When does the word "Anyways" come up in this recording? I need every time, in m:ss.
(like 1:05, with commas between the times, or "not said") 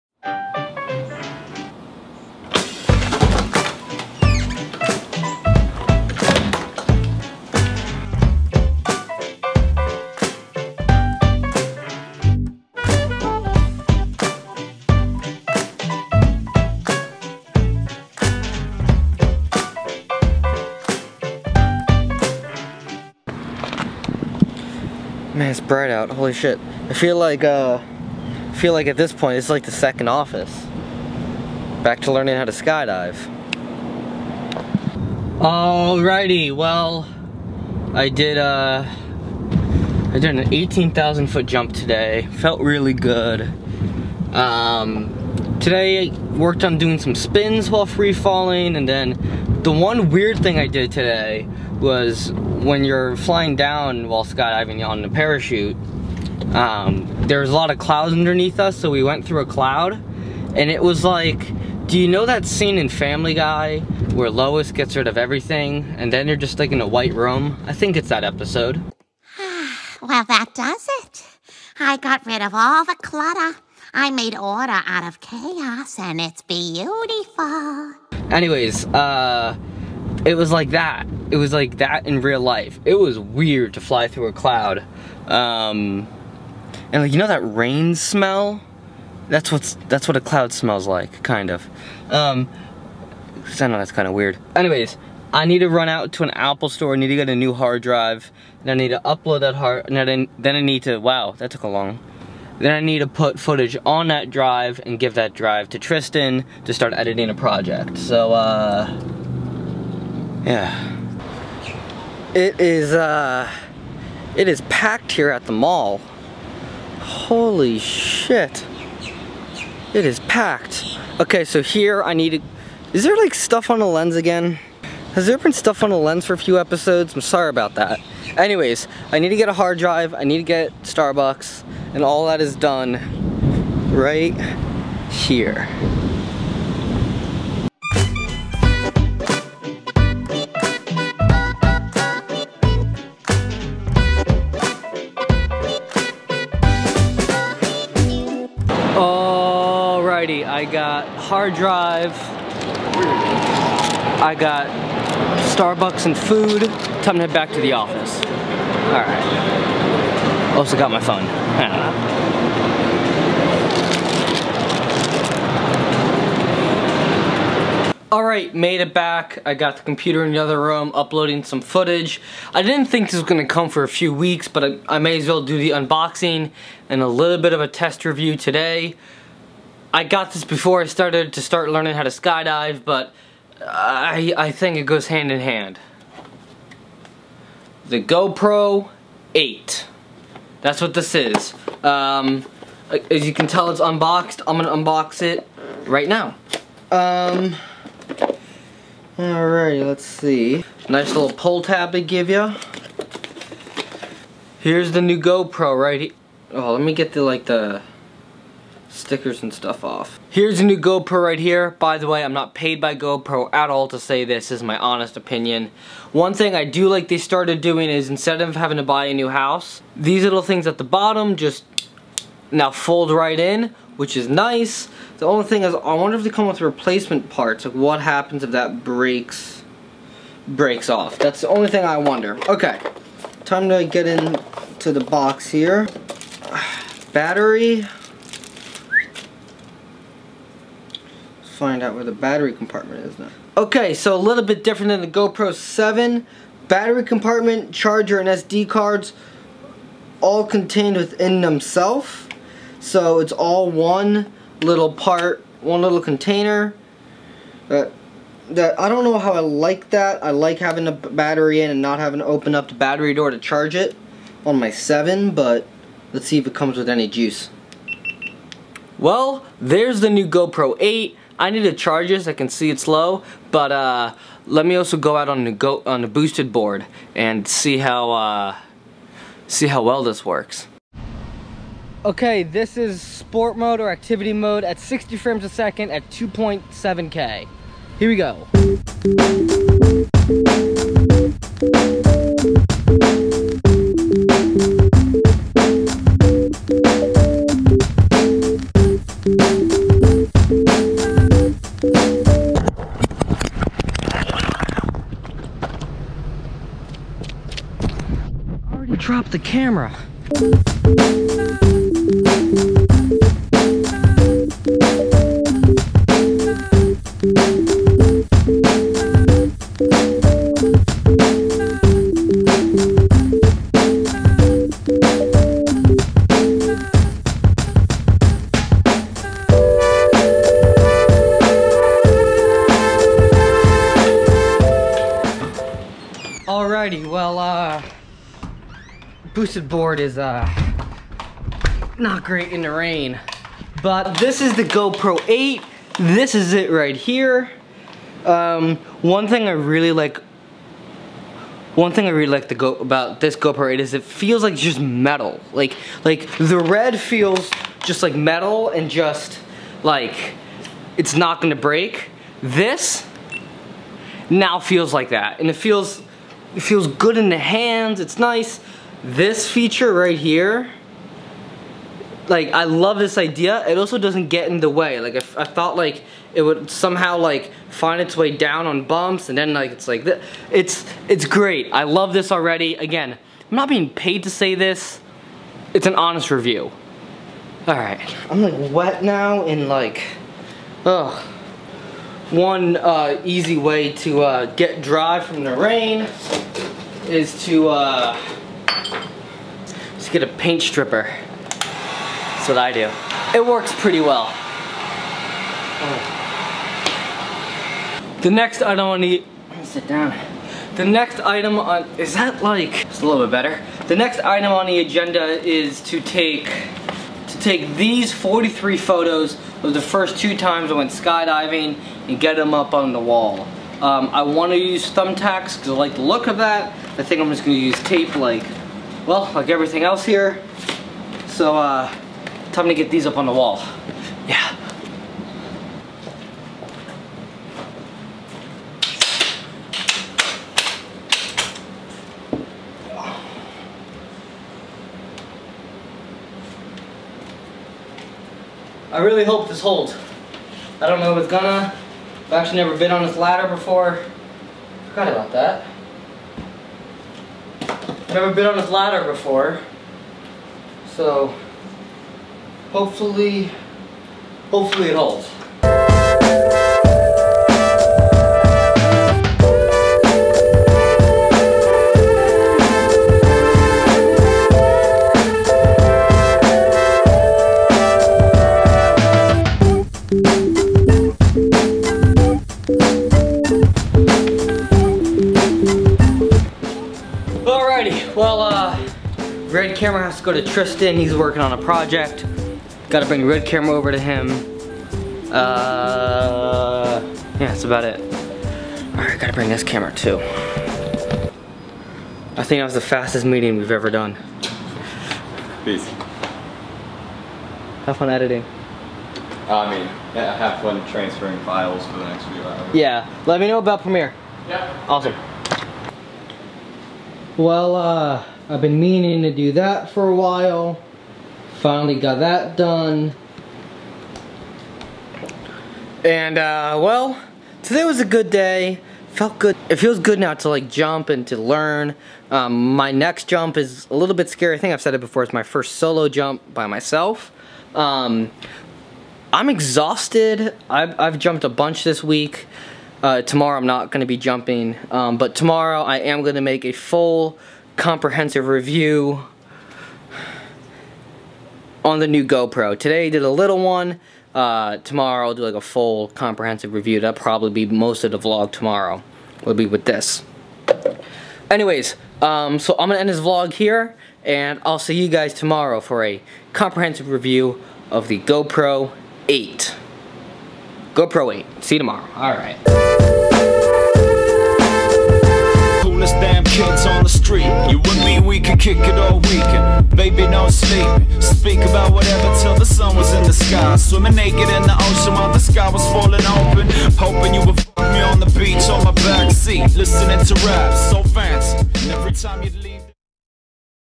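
1:18, 1:34, 2:08, 9:21.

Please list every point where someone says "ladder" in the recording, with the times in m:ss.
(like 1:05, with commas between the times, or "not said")
7:33, 7:38.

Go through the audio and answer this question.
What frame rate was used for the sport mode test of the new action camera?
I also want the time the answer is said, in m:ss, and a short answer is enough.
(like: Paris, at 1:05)
60 frames per second, at 4:44.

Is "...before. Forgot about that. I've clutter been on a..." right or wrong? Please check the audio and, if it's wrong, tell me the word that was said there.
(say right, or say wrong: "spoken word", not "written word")
wrong: "never", not "clutter".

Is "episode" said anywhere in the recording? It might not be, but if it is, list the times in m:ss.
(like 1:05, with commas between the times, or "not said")
1:08, 2:06.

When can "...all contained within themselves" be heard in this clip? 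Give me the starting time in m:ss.
4:10.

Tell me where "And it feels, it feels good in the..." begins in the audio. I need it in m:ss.
6:05.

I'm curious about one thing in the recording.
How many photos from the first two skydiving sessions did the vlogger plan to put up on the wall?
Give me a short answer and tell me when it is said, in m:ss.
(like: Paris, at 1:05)
43, at 6:58.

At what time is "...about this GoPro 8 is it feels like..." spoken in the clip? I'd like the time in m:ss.
5:52.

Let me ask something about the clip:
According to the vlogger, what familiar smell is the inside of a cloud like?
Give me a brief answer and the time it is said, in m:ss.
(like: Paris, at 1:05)
rain smell, at 1:27.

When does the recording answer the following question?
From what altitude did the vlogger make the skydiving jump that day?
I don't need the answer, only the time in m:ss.
0:40.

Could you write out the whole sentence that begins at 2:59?
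I got this before I started to start learning how to skydive, but I, I think it goes hand in hand.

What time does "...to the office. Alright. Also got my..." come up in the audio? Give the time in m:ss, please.
2:37.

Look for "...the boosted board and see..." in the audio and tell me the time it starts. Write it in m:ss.
4:36.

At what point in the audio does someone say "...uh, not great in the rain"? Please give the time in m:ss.
5:40.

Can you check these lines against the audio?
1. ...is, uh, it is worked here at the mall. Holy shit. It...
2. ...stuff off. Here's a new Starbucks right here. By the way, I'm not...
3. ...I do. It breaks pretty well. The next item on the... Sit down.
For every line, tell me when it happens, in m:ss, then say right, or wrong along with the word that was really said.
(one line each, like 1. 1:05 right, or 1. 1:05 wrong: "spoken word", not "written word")
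1. 1:52 wrong: "packed", not "worked"
2. 3:29 wrong: "GoPro", not "Starbucks"
3. 6:42 wrong: "works", not "breaks".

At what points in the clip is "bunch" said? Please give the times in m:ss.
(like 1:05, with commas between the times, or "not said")
9:01.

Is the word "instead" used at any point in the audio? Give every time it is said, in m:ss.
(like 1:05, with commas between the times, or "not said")
3:38.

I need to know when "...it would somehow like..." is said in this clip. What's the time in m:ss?
6:16.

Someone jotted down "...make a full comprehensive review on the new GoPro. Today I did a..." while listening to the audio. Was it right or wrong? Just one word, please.
right.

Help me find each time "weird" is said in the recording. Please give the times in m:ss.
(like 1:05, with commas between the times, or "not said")
0:50, 1:23, 1:34.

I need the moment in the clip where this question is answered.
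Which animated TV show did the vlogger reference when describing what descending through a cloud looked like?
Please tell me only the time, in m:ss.
1:02.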